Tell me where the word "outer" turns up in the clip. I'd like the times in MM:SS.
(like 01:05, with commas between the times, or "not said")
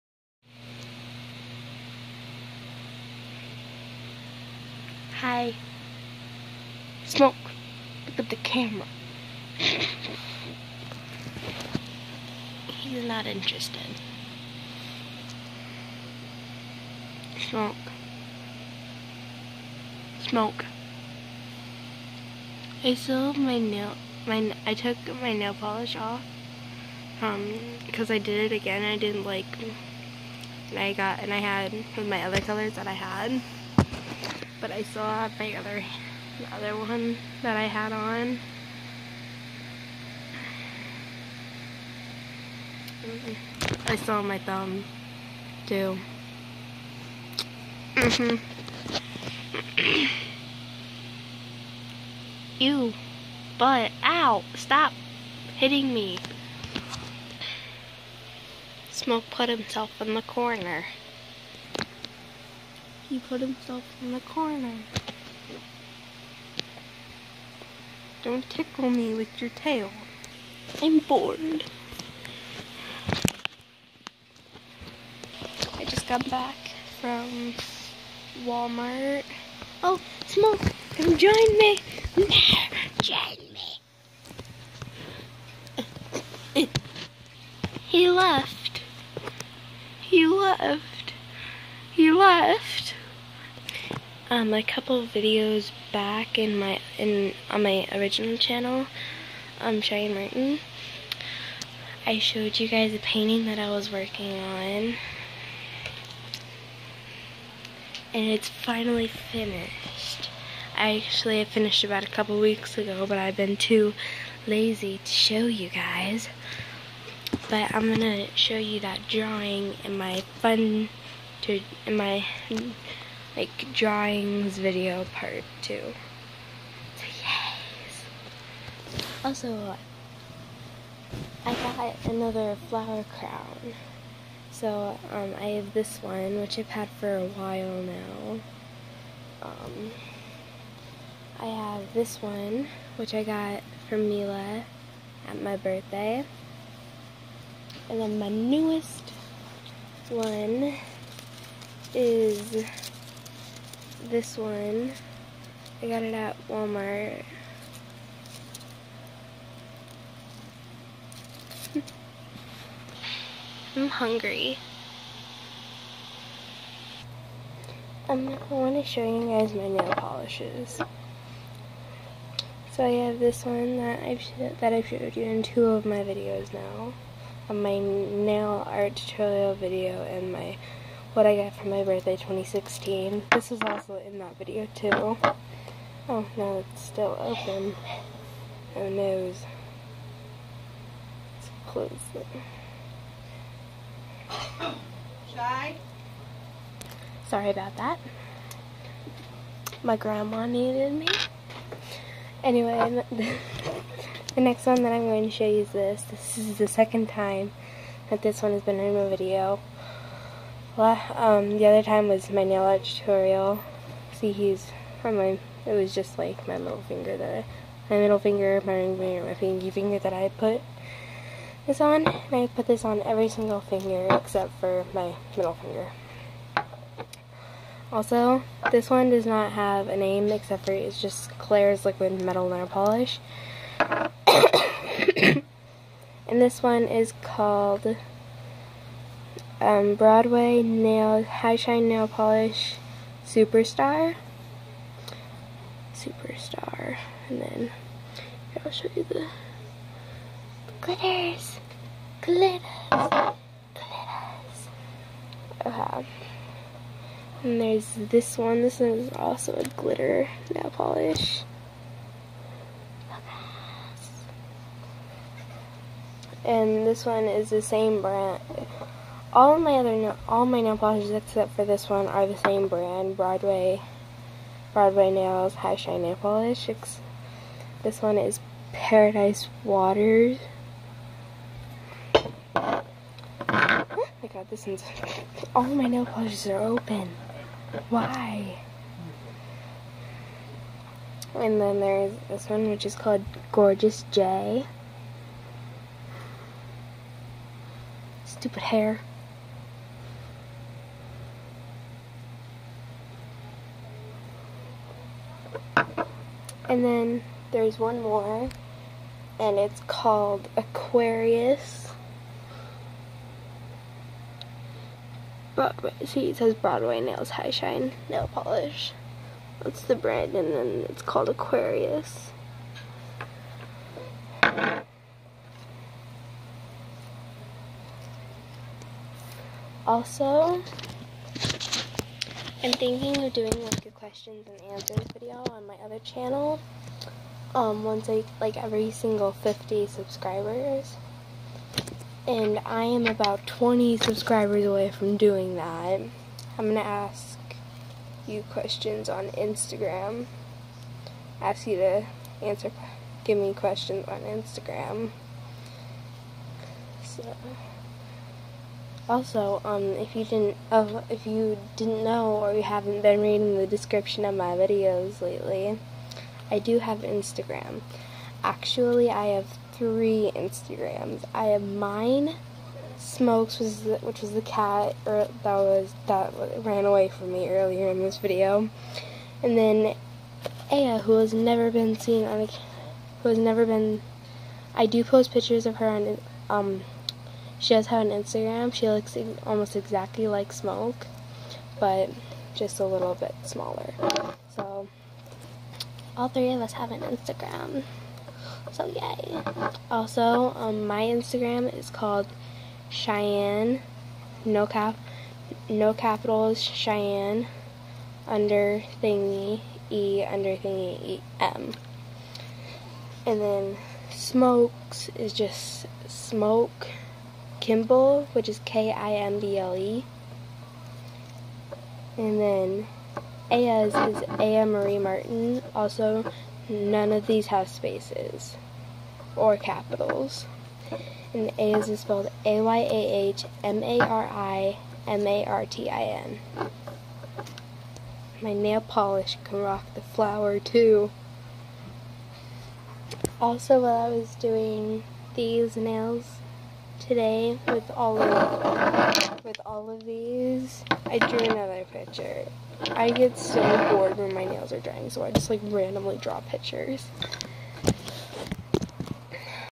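not said.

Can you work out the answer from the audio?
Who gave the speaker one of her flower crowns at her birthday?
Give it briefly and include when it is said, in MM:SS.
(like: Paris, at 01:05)
Mila, at 02:24.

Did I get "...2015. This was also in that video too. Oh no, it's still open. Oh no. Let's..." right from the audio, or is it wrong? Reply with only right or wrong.
wrong.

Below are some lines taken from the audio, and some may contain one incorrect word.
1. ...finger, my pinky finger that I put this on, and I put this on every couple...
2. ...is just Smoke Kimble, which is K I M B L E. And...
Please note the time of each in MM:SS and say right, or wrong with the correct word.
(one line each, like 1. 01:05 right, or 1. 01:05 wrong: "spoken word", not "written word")
1. 03:38 wrong: "single", not "couple"
2. 06:55 right.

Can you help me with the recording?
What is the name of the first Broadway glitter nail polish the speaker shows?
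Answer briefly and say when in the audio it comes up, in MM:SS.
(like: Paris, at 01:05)
Paradise Waters, at 04:38.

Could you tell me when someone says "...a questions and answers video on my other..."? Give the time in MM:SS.
05:33.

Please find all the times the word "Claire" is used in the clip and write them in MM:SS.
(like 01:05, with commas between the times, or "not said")
03:51.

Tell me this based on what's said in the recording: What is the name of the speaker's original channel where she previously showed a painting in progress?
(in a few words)
Shyann Martin.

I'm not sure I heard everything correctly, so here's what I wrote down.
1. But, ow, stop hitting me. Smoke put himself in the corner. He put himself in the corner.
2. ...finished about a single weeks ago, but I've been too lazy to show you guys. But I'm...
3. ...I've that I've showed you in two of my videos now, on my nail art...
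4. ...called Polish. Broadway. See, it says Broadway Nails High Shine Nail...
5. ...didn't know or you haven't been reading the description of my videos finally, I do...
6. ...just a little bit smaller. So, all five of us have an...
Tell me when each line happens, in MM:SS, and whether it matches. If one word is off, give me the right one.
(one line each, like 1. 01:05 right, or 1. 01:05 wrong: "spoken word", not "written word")
1. 00:53 right
2. 01:51 wrong: "couple", not "single"
3. 02:54 right
4. 05:09 wrong: "Aquarius", not "Polish"
5. 06:01 wrong: "lately", not "finally"
6. 06:32 wrong: "three", not "five".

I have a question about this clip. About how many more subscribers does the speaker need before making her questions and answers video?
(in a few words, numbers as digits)
20.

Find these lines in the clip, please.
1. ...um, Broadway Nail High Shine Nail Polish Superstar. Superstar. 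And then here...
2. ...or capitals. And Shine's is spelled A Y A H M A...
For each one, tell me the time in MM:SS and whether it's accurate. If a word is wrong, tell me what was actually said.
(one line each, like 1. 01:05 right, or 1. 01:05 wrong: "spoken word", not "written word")
1. 03:59 right
2. 07:09 wrong: "Ayah", not "Shine".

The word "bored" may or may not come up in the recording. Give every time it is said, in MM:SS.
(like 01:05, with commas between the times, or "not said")
01:10, 07:33.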